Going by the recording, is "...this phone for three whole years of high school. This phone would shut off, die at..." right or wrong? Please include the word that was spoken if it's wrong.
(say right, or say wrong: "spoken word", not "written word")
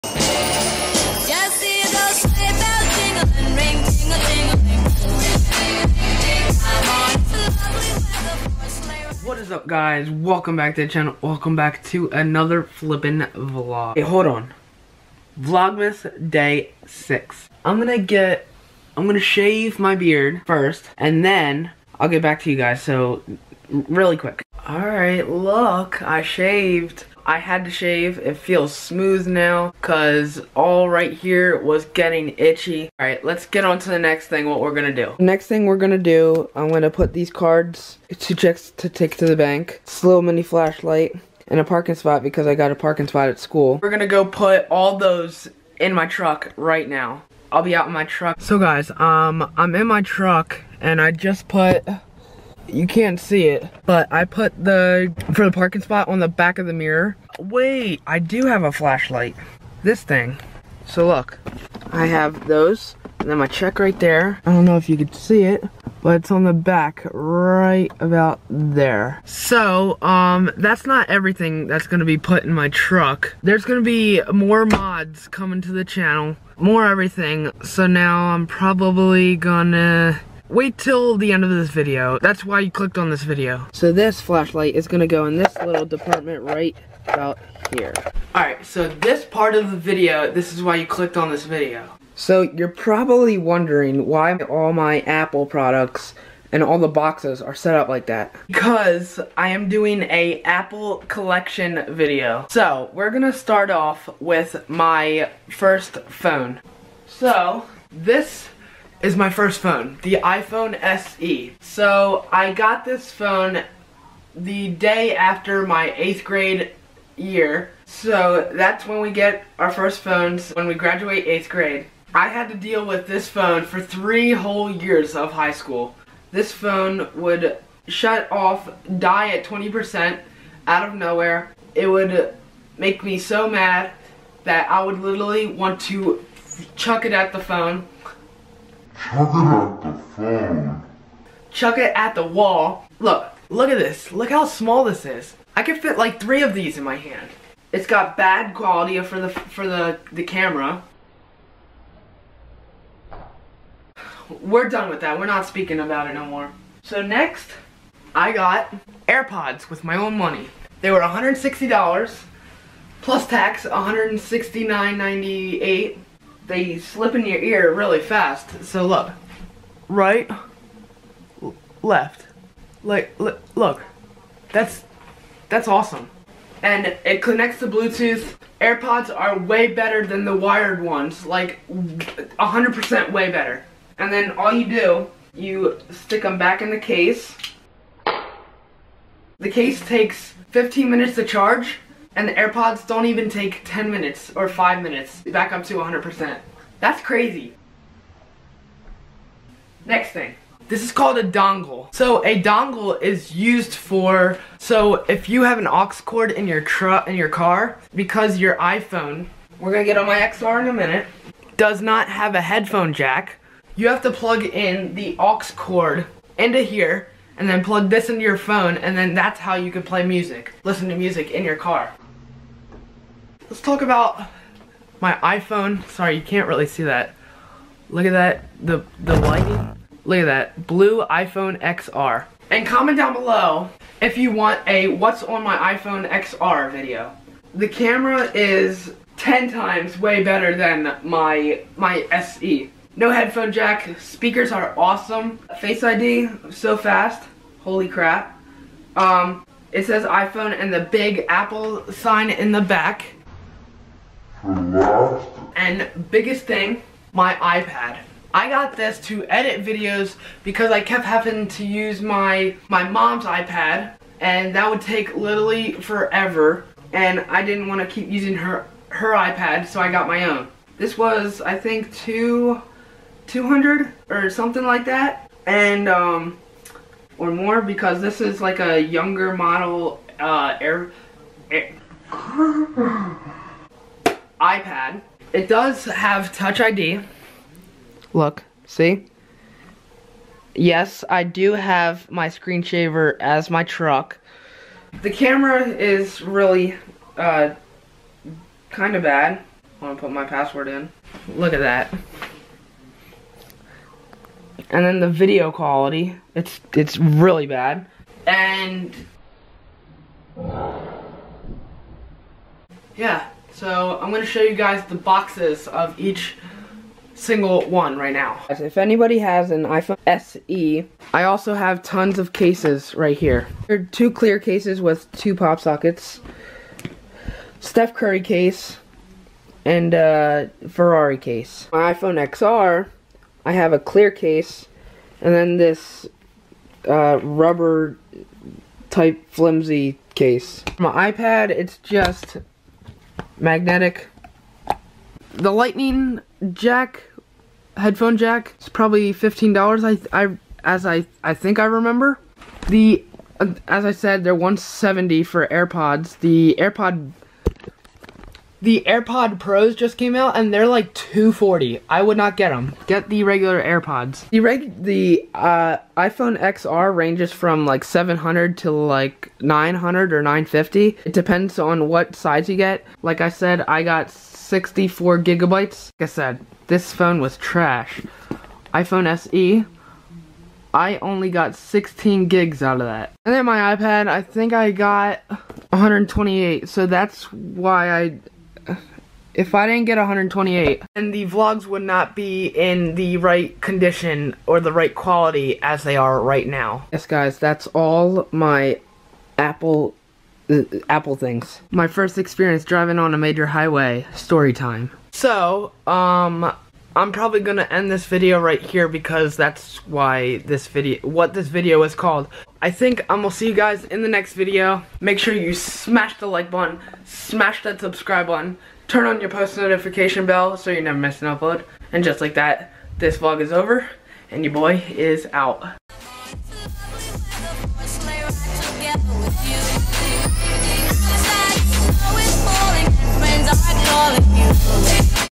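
right.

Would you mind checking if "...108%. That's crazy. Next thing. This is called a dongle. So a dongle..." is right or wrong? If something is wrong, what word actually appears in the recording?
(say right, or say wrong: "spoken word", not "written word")
wrong: "100", not "108".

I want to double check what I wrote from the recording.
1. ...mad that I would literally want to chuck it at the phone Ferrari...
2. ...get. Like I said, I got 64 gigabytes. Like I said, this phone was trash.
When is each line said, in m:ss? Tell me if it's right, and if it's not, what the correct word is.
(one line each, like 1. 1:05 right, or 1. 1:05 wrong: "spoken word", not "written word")
1. 2:13 wrong: "Chuck", not "Ferrari"
2. 6:12 right.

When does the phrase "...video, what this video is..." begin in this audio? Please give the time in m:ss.
6:50.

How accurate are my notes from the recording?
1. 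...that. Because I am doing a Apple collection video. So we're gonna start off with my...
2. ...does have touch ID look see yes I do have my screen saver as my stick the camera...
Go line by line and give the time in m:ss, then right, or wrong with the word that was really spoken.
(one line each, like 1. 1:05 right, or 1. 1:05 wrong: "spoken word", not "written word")
1. 1:38 right
2. 4:45 wrong: "truck", not "stick".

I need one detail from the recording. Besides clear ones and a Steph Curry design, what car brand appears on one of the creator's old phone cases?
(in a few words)
Ferrari.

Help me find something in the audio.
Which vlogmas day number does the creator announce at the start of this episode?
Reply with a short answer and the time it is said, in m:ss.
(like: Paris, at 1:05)
6, at 0:15.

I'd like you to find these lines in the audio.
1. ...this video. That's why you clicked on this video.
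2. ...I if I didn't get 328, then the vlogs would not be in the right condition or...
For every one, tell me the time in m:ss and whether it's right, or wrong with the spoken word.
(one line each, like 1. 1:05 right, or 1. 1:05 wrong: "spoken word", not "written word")
1. 1:21 right
2. 6:28 wrong: "128", not "328".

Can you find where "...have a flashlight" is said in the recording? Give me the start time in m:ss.
0:58.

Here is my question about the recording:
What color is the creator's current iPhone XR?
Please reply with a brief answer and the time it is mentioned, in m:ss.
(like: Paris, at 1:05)
blue, at 3:50.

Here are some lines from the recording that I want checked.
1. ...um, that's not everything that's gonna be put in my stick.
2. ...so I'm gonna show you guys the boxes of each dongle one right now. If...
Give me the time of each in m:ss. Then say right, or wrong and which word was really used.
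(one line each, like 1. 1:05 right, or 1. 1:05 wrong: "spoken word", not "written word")
1. 1:10 wrong: "truck", not "stick"
2. 5:13 wrong: "single", not "dongle".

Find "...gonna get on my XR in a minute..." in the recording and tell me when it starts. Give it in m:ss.
3:29.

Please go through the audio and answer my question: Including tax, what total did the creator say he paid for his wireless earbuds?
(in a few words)
$169.98.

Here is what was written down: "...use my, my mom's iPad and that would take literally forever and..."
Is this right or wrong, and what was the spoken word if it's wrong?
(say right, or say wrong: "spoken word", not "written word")
right.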